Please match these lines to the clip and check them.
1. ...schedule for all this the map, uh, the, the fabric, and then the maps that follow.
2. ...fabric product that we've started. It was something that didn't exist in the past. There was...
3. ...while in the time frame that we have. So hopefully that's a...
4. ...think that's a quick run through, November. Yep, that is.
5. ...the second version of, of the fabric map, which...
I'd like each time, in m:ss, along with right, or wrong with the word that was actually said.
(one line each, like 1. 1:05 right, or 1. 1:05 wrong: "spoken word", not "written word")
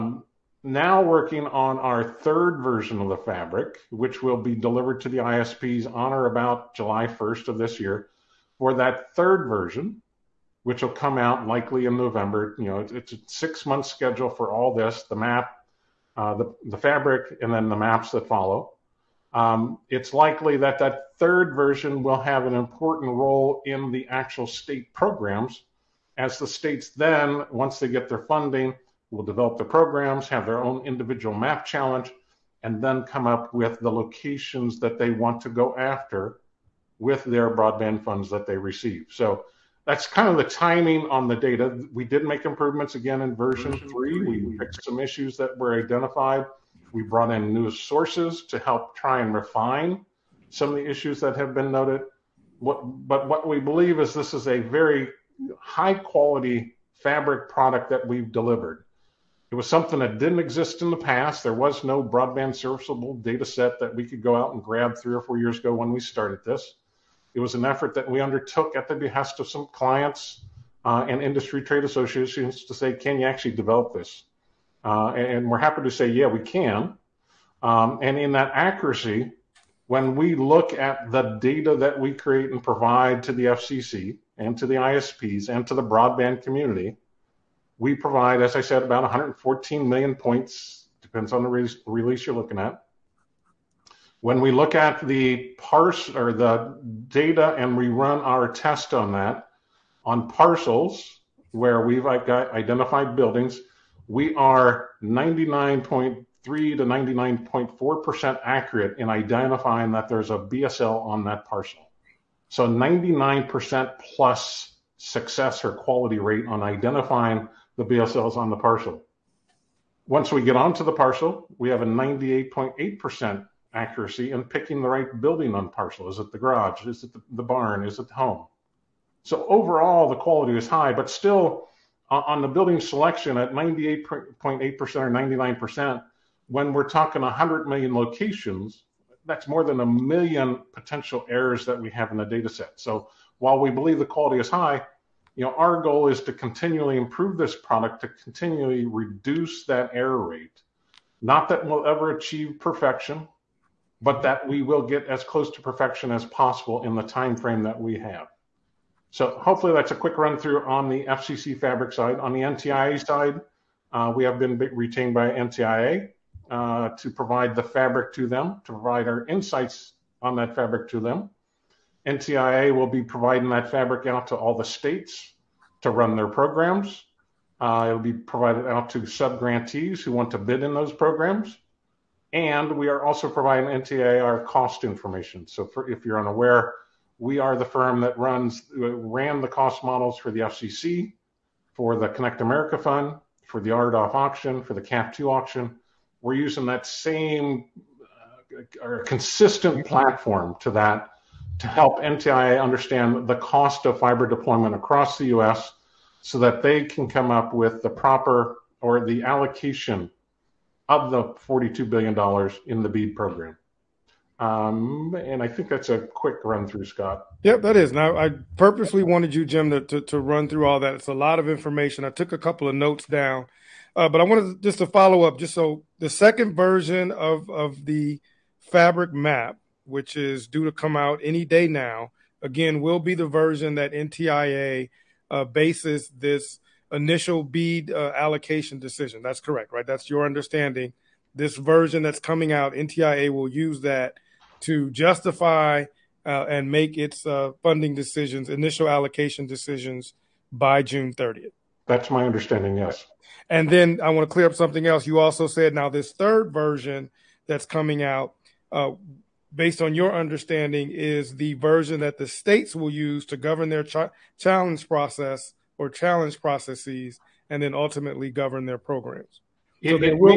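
1. 0:13 right
2. 0:56 wrong: "delivered", not "started"
3. 2:36 wrong: "possible", not "while"
4. 3:35 wrong: "Scott", not "November"
5. 3:45 right.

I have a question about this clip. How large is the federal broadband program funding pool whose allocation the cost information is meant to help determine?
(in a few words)
$42 billion.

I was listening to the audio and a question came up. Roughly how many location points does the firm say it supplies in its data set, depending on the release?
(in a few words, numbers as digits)
114 million.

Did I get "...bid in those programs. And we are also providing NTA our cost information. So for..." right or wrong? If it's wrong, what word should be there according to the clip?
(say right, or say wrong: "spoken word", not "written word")
right.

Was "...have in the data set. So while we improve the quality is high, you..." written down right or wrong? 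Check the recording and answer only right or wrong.
wrong.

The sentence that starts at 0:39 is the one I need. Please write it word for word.
So that's kind of the timing on the data.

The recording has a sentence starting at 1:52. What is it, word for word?
So 99% plus success or quality rate on identifying the BSLs on the parcel.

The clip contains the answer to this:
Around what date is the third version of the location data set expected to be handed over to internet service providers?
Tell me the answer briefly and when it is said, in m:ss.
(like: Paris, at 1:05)
July 1st, at 0:06.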